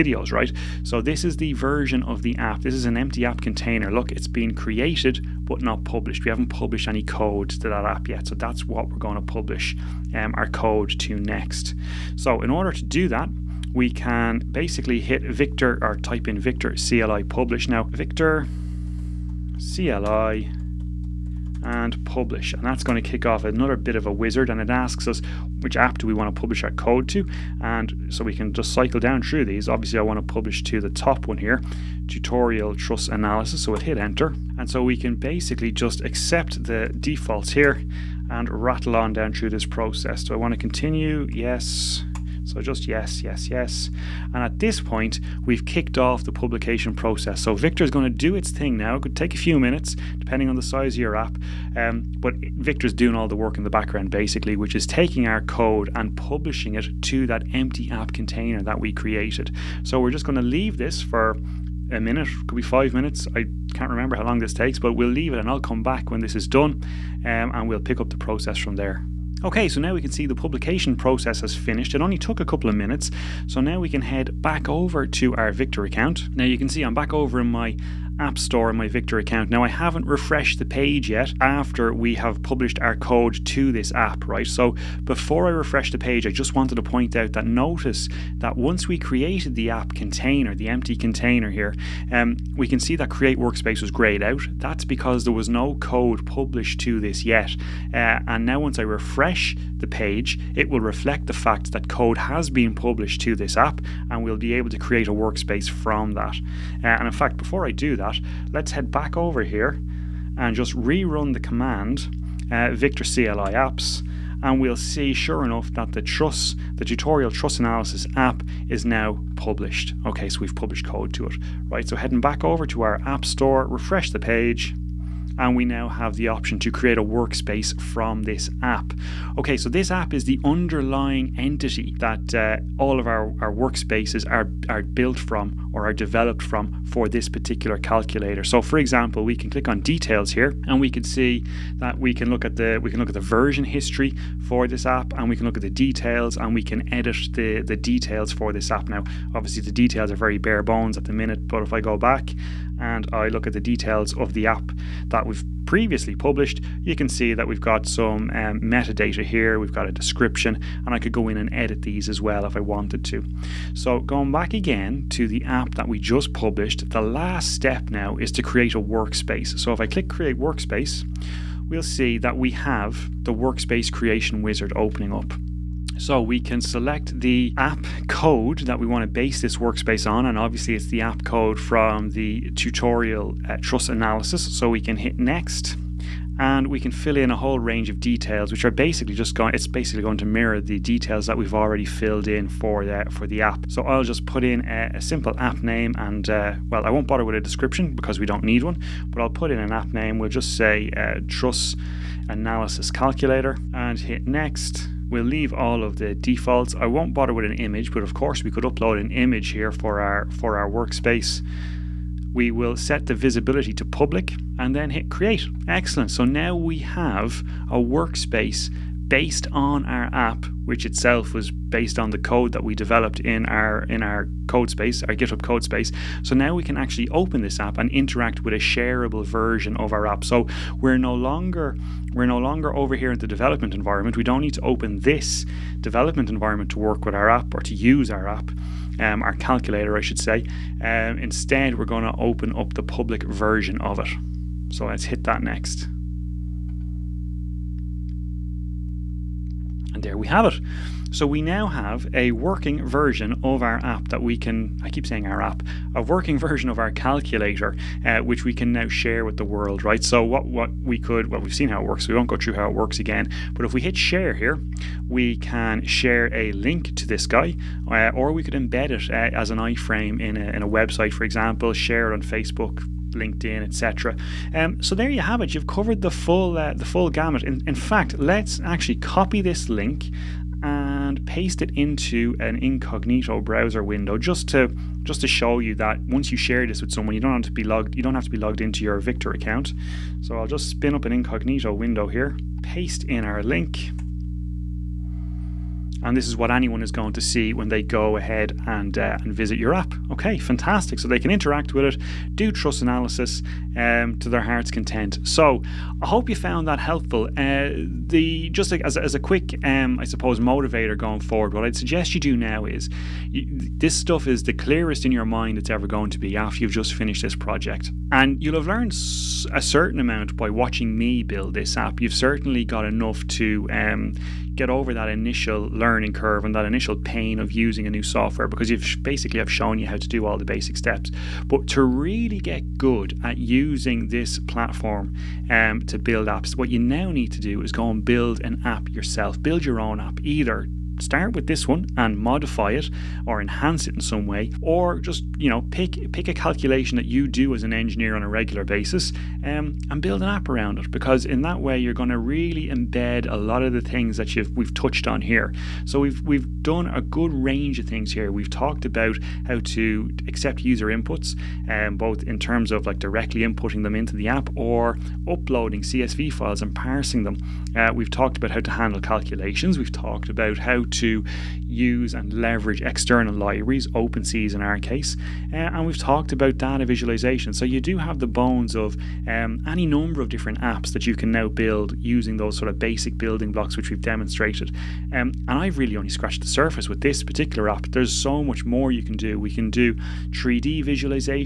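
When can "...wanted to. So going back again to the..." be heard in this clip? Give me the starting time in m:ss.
2:42.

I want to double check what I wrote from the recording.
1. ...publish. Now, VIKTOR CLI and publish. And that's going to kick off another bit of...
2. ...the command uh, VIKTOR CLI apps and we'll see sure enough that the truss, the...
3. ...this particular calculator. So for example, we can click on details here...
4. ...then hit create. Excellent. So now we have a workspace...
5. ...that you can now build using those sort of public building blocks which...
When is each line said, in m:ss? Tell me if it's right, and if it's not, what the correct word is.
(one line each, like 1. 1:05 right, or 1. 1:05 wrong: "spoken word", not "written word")
1. 0:17 right
2. 1:51 right
3. 2:17 right
4. 3:34 right
5. 6:20 wrong: "basic", not "public".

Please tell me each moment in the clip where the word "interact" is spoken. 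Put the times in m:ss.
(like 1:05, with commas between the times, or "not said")
3:47, 5:01.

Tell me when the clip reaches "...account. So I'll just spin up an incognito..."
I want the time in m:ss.
4:49.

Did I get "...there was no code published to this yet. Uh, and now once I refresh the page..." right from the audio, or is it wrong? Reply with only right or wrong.
right.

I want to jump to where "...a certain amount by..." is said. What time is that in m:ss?
5:19.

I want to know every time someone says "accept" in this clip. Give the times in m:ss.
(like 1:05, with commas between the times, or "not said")
0:36, 6:00.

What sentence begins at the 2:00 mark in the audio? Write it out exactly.
Okay, so we've published code to it.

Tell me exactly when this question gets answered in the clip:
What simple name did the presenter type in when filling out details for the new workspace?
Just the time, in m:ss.
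3:22.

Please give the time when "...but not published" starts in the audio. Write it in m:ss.
0:05.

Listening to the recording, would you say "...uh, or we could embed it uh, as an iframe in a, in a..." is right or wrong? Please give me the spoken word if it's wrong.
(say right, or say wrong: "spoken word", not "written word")
right.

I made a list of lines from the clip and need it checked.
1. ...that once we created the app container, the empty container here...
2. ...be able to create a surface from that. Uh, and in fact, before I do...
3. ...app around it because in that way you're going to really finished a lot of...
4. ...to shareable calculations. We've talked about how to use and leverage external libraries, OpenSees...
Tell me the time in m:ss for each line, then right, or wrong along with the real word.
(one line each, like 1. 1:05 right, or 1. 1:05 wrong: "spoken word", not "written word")
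1. 1:28 right
2. 1:44 wrong: "workspace", not "surface"
3. 5:50 wrong: "embed", not "finished"
4. 6:08 wrong: "handle", not "shareable".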